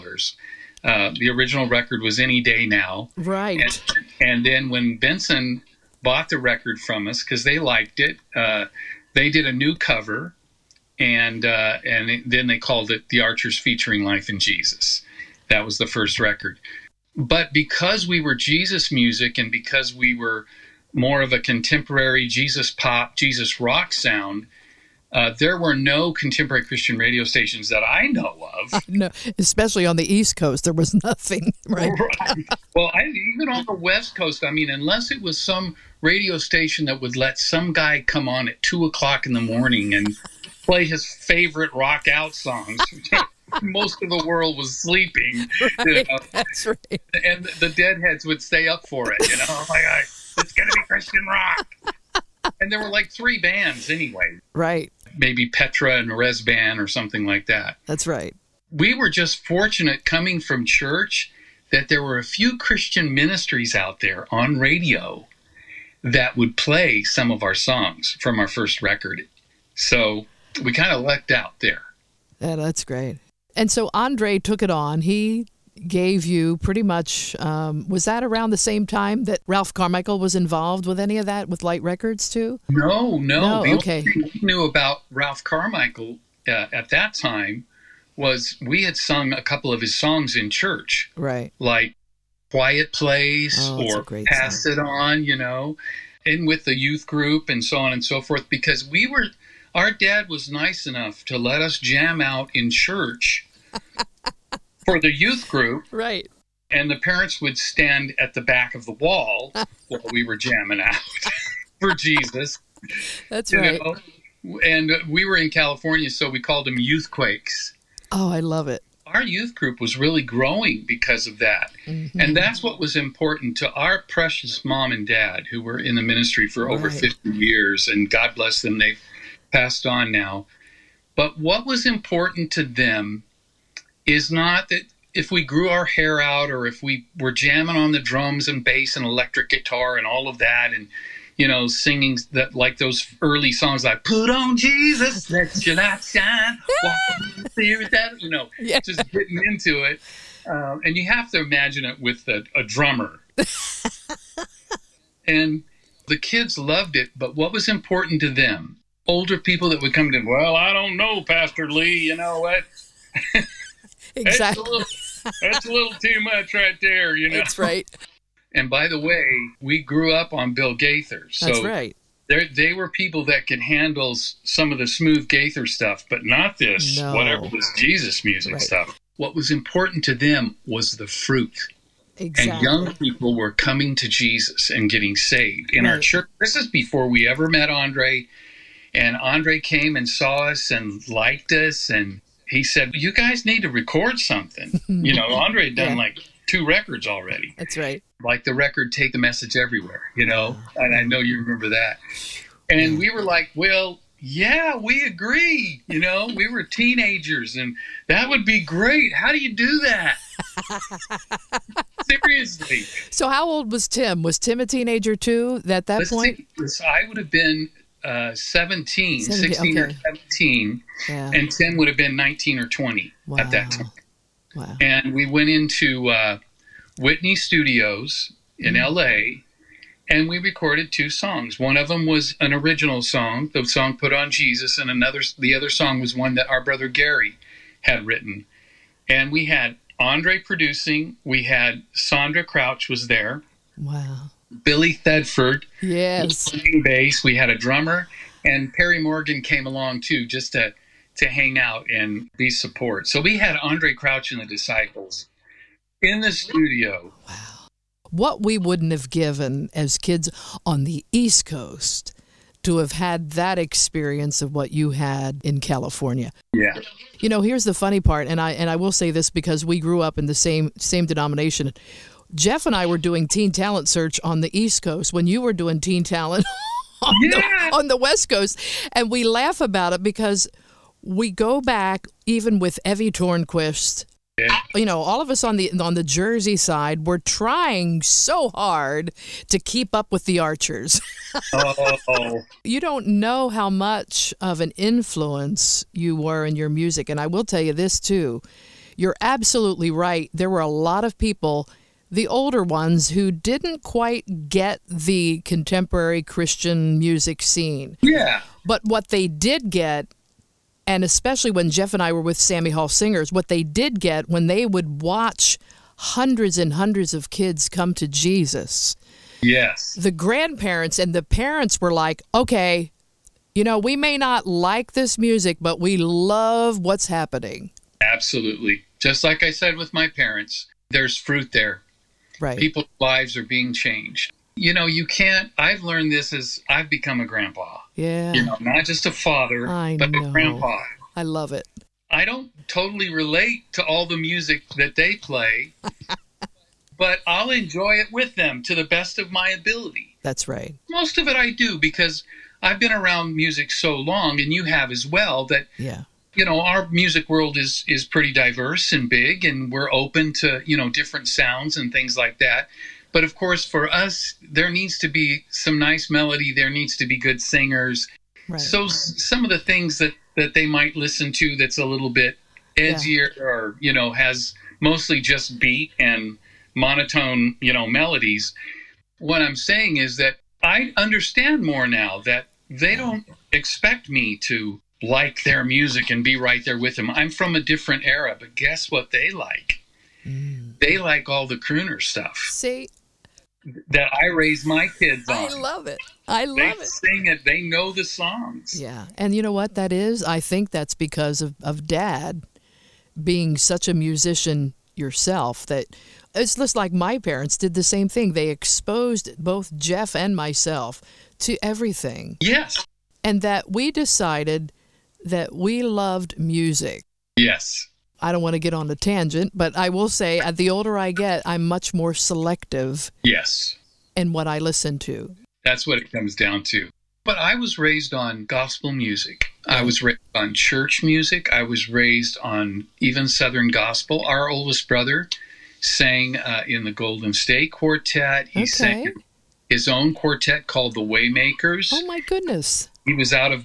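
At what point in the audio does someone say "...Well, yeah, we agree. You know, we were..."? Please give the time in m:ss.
3:23.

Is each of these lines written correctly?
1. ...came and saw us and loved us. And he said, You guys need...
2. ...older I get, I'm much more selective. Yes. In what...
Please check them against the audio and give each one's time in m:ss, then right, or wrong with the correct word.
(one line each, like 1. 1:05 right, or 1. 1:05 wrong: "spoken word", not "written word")
1. 3:09 wrong: "liked", not "loved"
2. 7:00 right.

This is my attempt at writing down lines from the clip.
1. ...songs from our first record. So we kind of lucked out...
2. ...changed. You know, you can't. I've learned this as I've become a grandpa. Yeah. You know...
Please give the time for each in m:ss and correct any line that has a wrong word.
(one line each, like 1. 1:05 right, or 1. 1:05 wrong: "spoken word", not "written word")
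1. 1:07 right
2. 5:33 right.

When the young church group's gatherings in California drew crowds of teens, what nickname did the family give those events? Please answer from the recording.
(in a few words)
youth quakes.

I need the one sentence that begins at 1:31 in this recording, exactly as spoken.
Like Quiet Place oh, or Pass song.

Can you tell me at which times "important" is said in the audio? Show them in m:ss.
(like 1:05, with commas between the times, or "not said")
2:02, 2:11, 2:37, 2:59.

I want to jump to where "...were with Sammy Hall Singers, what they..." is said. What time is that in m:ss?
5:12.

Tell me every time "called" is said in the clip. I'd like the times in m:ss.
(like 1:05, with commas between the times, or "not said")
0:12, 1:56, 7:20.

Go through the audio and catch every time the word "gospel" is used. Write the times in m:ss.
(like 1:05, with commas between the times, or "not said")
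7:08, 7:13.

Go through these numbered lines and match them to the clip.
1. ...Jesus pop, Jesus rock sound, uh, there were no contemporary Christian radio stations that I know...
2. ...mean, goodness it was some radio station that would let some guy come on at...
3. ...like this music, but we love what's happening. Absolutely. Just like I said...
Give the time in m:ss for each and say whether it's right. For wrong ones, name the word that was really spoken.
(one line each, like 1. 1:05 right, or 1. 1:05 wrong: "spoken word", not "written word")
1. 0:22 right
2. 0:34 wrong: "unless", not "goodness"
3. 5:24 right.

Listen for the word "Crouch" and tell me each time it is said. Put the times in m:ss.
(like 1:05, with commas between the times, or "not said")
4:02, 4:13.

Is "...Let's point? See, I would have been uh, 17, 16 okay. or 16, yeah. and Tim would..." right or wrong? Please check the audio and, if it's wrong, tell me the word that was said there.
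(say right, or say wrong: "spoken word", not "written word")
wrong: "17", not "16".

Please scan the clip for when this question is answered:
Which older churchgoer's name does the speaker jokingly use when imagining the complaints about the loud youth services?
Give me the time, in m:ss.
2:41.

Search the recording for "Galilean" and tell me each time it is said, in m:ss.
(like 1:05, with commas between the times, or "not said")
not said.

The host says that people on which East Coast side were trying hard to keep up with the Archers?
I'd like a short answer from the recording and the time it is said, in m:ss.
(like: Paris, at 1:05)
Jersey, at 4:46.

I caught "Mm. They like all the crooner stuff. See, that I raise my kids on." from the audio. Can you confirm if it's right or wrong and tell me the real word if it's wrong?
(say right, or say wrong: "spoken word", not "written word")
right.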